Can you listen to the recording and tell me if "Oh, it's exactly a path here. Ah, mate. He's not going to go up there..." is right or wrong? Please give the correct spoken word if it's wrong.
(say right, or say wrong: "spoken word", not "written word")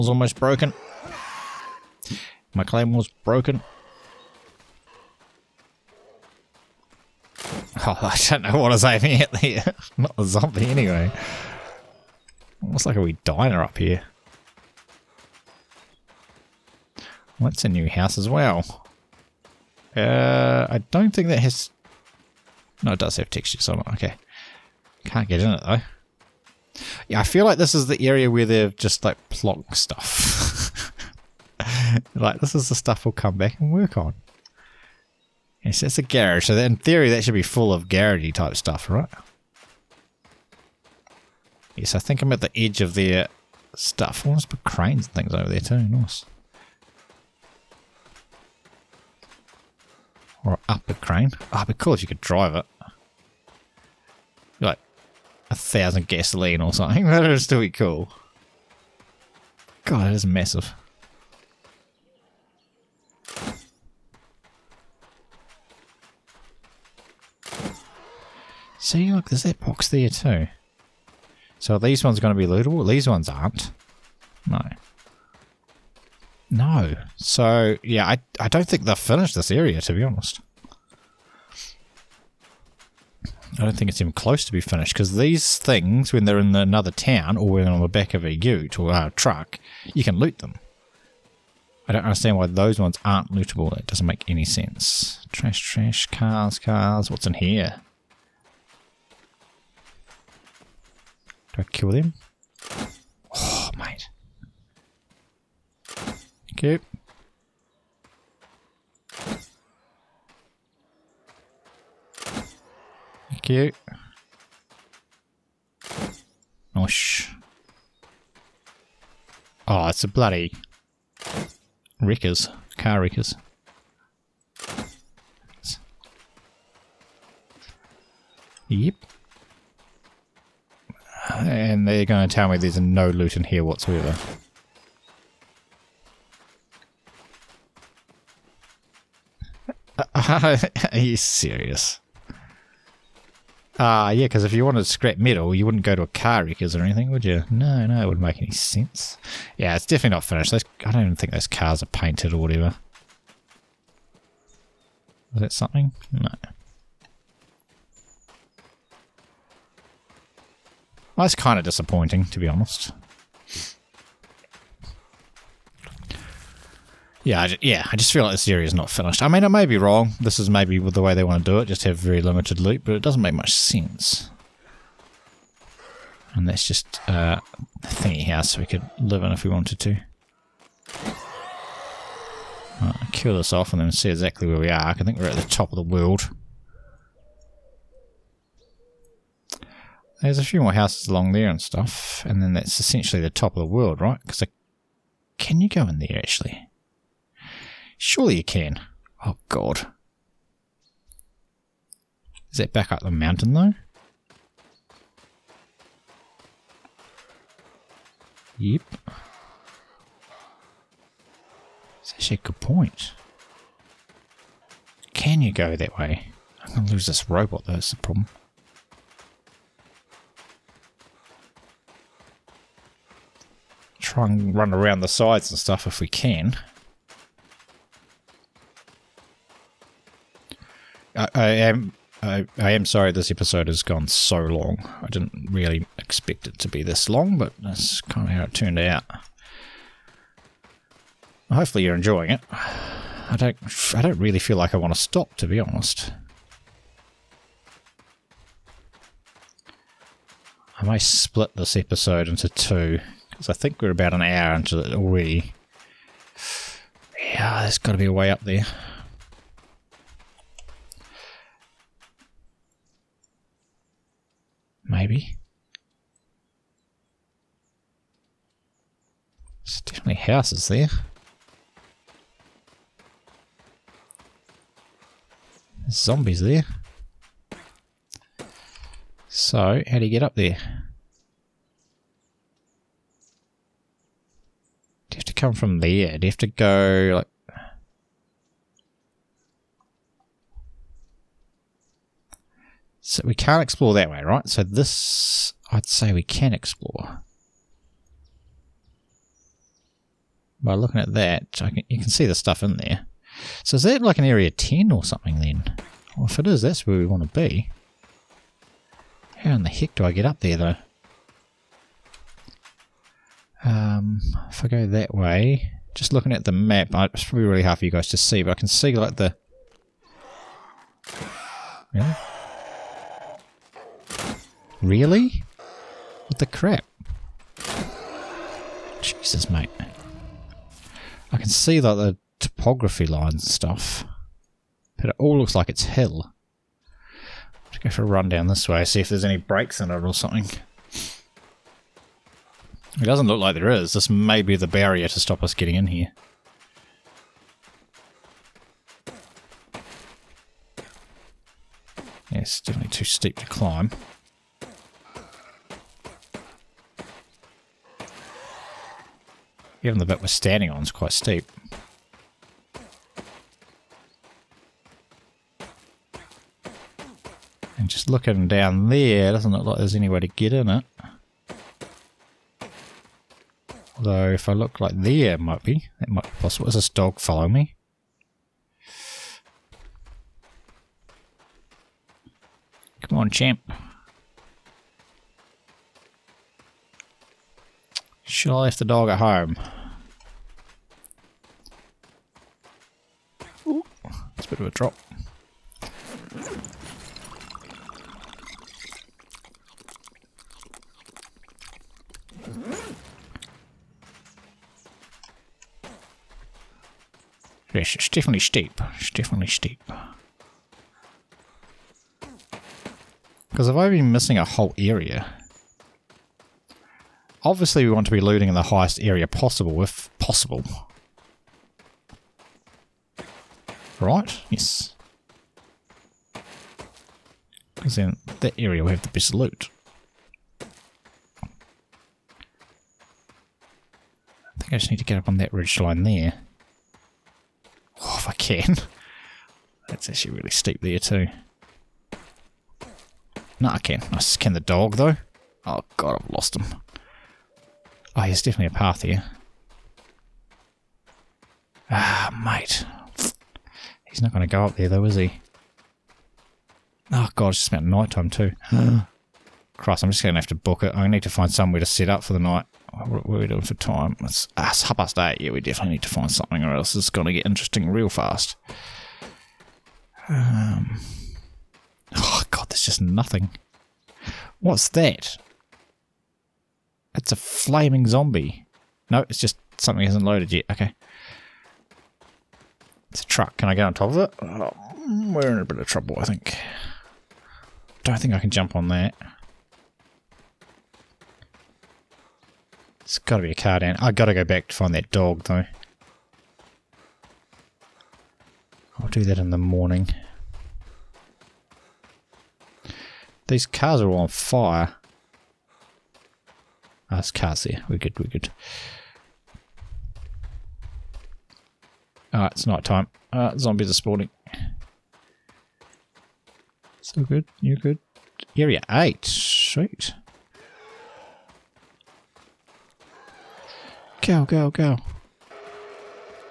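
wrong: "definitely", not "exactly".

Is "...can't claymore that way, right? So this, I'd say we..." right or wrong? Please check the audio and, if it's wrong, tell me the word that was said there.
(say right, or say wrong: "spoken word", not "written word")
wrong: "explore", not "claymore".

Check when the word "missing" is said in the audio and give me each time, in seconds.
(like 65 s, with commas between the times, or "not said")
414 s.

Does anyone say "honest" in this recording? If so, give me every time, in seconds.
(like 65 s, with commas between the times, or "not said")
80 s, 162 s, 245 s.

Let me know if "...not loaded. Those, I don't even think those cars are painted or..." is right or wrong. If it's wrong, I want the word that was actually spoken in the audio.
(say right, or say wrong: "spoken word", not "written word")
wrong: "finished", not "loaded".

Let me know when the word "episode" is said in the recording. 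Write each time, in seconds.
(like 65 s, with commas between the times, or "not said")
233 s, 251 s.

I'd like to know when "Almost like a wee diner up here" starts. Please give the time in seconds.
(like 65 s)
12 s.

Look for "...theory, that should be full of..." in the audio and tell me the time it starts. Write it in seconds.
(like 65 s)
36 s.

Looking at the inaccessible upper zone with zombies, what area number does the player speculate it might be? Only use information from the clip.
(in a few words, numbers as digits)
area 10.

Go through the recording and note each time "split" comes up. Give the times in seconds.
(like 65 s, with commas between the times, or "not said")
250 s.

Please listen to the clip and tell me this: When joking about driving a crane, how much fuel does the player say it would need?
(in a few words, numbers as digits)
1000 gasoline.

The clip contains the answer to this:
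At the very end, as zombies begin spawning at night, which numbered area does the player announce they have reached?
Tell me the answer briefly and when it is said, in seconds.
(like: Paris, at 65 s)
Area 8, at 518 s.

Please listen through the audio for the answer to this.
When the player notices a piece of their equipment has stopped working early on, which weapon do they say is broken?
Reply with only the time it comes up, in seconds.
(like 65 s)
2 s.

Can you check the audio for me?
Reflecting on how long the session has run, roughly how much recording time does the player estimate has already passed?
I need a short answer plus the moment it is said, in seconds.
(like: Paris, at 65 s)
an hour, at 254 s.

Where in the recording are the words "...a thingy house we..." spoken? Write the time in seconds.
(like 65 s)
177 s.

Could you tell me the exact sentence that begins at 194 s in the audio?
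Because can you go in there actually?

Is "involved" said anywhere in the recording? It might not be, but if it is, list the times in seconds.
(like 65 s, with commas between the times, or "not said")
not said.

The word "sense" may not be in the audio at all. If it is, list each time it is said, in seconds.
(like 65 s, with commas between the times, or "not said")
94 s, 148 s, 173 s.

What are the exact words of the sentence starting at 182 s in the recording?
Right, kill this off and then see exactly where we are.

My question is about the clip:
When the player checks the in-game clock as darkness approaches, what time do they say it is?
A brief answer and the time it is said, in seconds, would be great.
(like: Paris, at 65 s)
half past eight, at 464 s.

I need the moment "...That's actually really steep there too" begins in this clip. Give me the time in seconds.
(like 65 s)
439 s.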